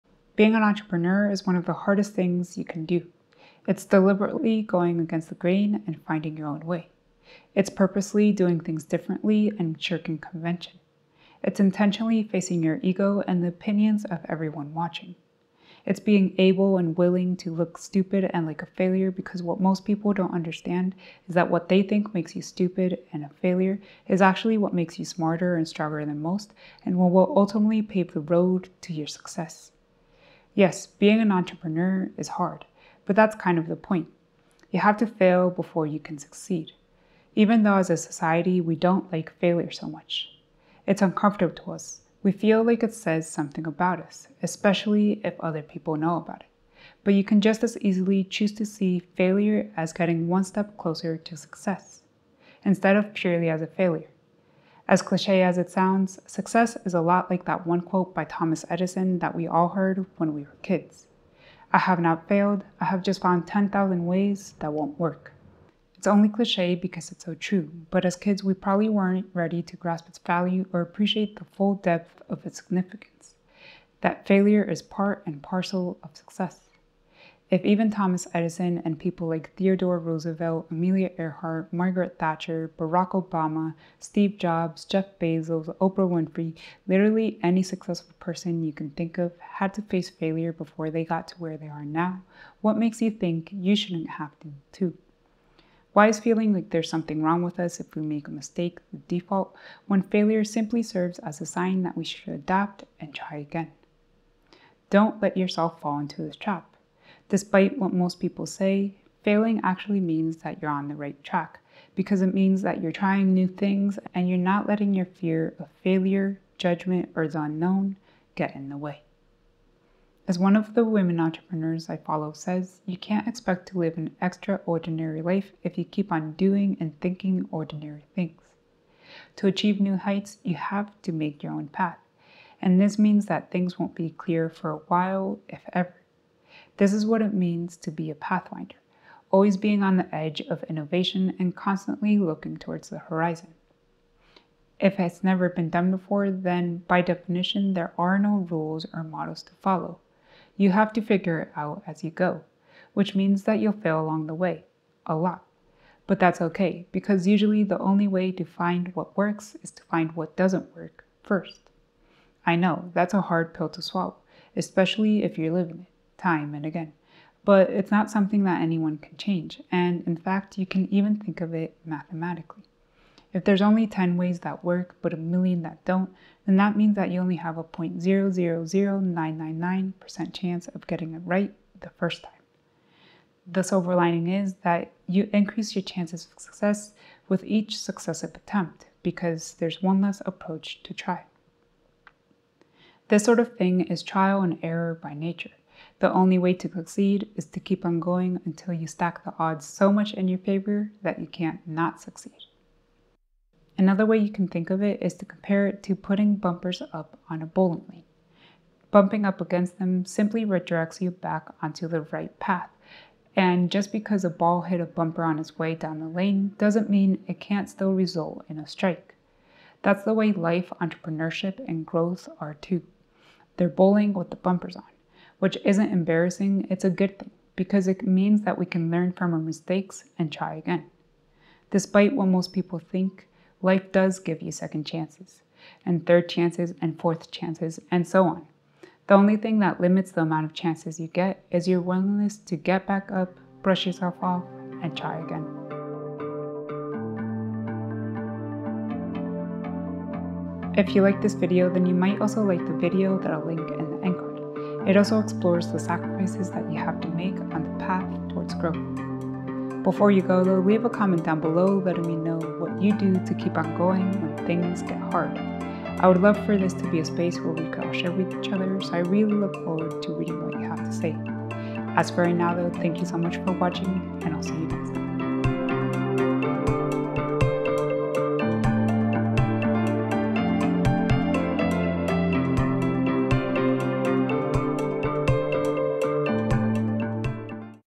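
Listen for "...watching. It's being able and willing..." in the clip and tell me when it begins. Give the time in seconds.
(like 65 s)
14 s.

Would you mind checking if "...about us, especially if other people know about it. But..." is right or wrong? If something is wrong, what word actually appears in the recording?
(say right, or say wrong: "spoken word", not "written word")
right.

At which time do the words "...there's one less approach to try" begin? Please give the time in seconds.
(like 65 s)
189 s.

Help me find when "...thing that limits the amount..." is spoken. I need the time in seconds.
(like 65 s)
239 s.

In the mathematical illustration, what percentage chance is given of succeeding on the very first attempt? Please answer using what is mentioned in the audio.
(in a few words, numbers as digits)
0.000999%.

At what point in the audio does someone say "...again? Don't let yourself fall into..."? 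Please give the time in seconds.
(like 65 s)
103 s.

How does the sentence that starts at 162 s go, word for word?
I know, that's a hard pill to swallow, especially if you're living it time and again.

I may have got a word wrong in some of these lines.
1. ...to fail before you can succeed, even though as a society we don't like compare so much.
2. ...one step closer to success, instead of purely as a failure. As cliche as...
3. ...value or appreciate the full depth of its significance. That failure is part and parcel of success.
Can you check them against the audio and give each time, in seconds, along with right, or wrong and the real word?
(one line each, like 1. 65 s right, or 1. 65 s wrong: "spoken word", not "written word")
1. 34 s wrong: "failure", not "compare"
2. 50 s right
3. 70 s right.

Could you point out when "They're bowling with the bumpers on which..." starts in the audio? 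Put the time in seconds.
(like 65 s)
223 s.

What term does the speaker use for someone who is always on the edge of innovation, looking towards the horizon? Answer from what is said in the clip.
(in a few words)
Pathfinder.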